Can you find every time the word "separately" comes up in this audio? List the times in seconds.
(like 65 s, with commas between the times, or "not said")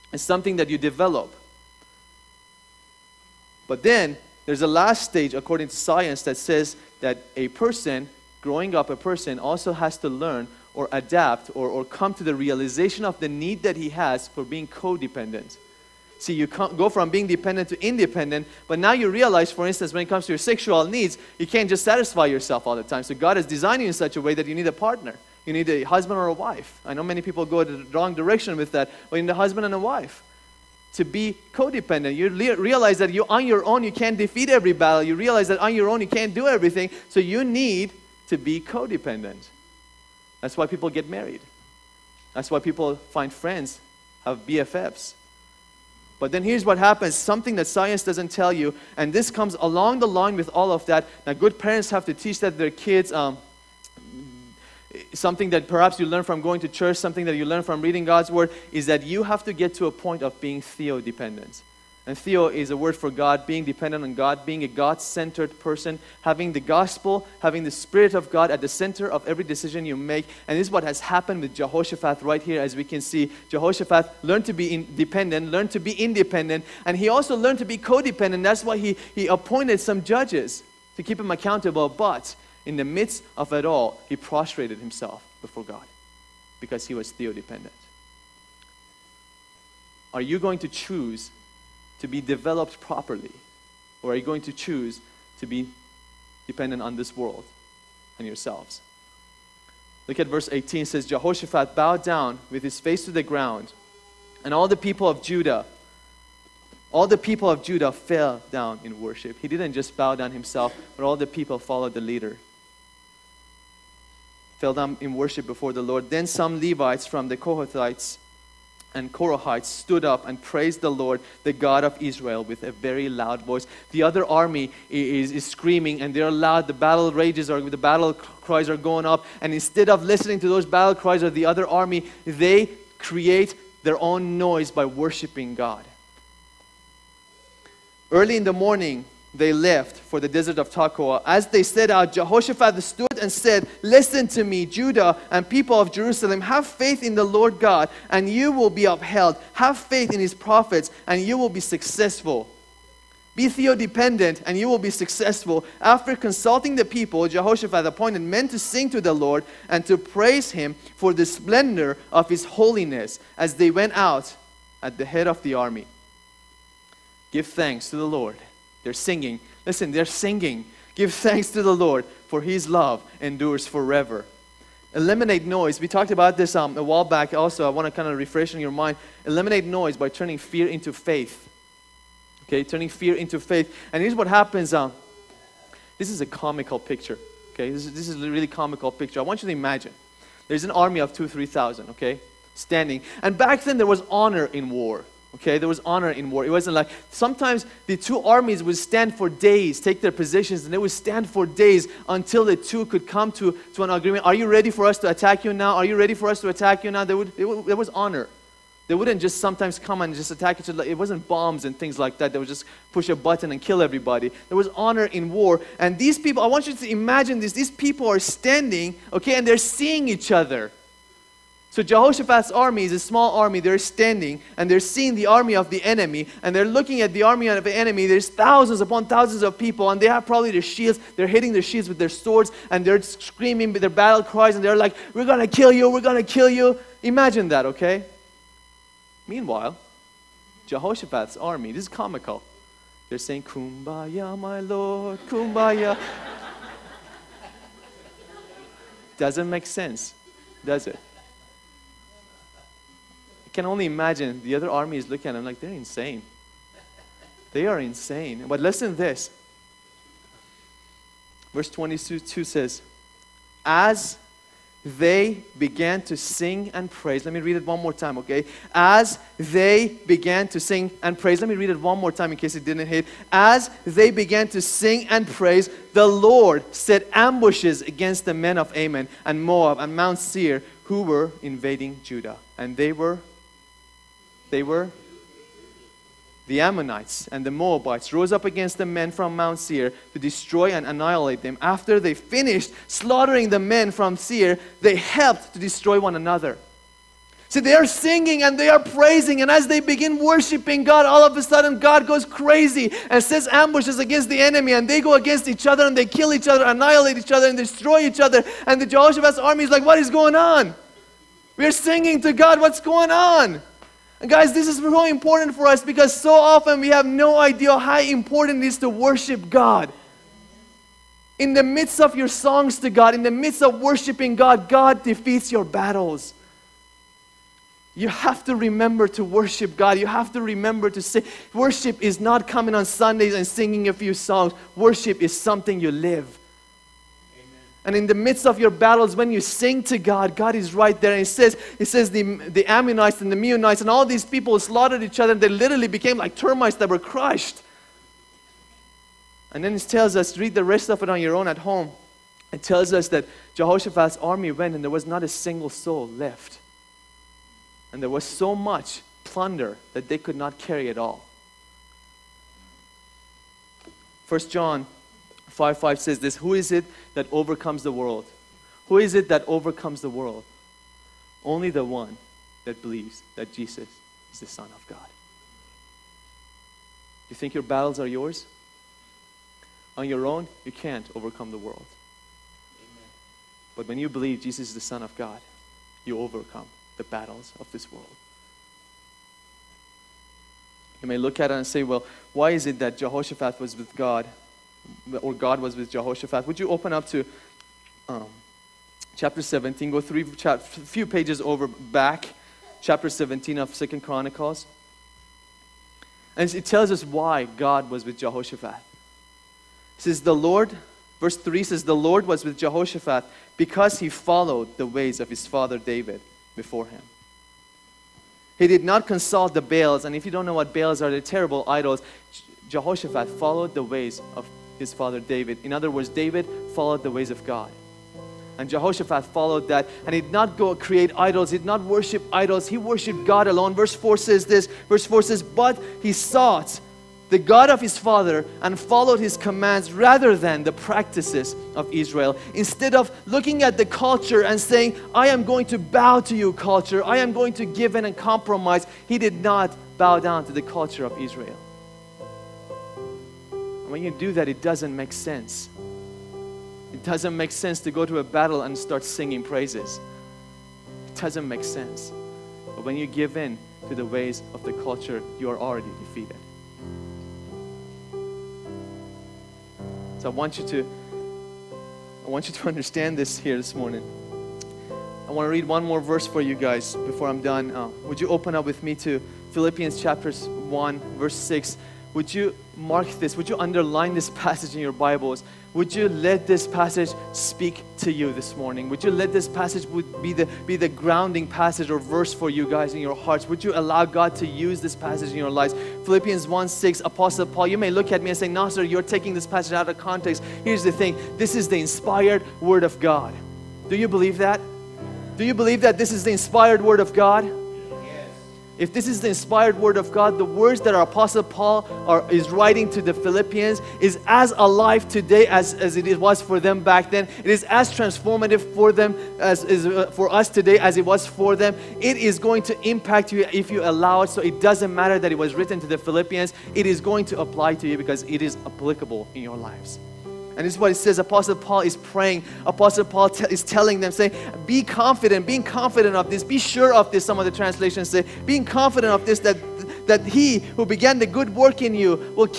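not said.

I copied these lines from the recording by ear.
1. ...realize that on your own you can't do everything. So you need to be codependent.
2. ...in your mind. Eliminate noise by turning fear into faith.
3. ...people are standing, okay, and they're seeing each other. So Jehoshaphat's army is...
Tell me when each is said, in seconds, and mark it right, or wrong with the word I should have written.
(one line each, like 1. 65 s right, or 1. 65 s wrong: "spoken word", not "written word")
1. 35 s right
2. 178 s right
3. 217 s right.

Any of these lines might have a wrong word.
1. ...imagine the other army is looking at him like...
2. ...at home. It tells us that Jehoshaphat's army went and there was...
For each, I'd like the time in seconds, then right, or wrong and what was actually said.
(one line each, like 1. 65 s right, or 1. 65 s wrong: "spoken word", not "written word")
1. 253 s right
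2. 351 s right.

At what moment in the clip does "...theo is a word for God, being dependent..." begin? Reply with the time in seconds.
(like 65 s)
62 s.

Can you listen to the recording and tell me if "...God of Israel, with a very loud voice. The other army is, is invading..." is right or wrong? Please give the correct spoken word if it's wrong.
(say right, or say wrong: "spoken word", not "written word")
wrong: "screaming", not "invading".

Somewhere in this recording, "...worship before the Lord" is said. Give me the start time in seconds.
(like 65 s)
115 s.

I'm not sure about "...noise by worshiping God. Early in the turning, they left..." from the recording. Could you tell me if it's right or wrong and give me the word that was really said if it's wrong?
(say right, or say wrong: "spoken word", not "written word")
wrong: "morning", not "turning".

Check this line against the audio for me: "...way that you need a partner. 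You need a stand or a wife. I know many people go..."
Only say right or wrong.
wrong.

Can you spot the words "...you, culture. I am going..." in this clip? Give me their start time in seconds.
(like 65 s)
446 s.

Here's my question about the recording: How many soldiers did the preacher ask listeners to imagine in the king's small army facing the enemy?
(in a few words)
3,000.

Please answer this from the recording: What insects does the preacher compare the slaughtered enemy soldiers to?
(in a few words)
termites.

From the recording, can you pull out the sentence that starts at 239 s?
Meanwhile, Jehoshaphat's army, this is comical.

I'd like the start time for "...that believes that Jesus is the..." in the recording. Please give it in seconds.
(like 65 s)
372 s.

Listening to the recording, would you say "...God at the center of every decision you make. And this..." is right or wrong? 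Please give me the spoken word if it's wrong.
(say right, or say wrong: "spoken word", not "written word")
right.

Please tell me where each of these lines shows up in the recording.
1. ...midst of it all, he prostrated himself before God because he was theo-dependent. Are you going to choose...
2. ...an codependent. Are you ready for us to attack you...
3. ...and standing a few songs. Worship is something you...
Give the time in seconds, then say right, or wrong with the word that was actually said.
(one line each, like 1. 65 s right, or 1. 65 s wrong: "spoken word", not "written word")
1. 82 s right
2. 203 s wrong: "agreement", not "codependent"
3. 333 s wrong: "singing", not "standing".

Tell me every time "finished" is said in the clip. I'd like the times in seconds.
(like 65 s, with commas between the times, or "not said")
292 s.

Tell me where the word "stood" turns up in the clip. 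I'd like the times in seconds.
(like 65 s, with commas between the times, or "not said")
119 s, 142 s.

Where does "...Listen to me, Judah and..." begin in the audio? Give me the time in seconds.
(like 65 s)
143 s.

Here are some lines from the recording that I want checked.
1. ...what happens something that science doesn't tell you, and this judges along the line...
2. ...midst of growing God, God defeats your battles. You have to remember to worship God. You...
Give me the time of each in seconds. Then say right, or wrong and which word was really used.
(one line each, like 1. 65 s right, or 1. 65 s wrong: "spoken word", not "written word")
1. 46 s wrong: "comes", not "judges"
2. 323 s wrong: "worshiping", not "growing".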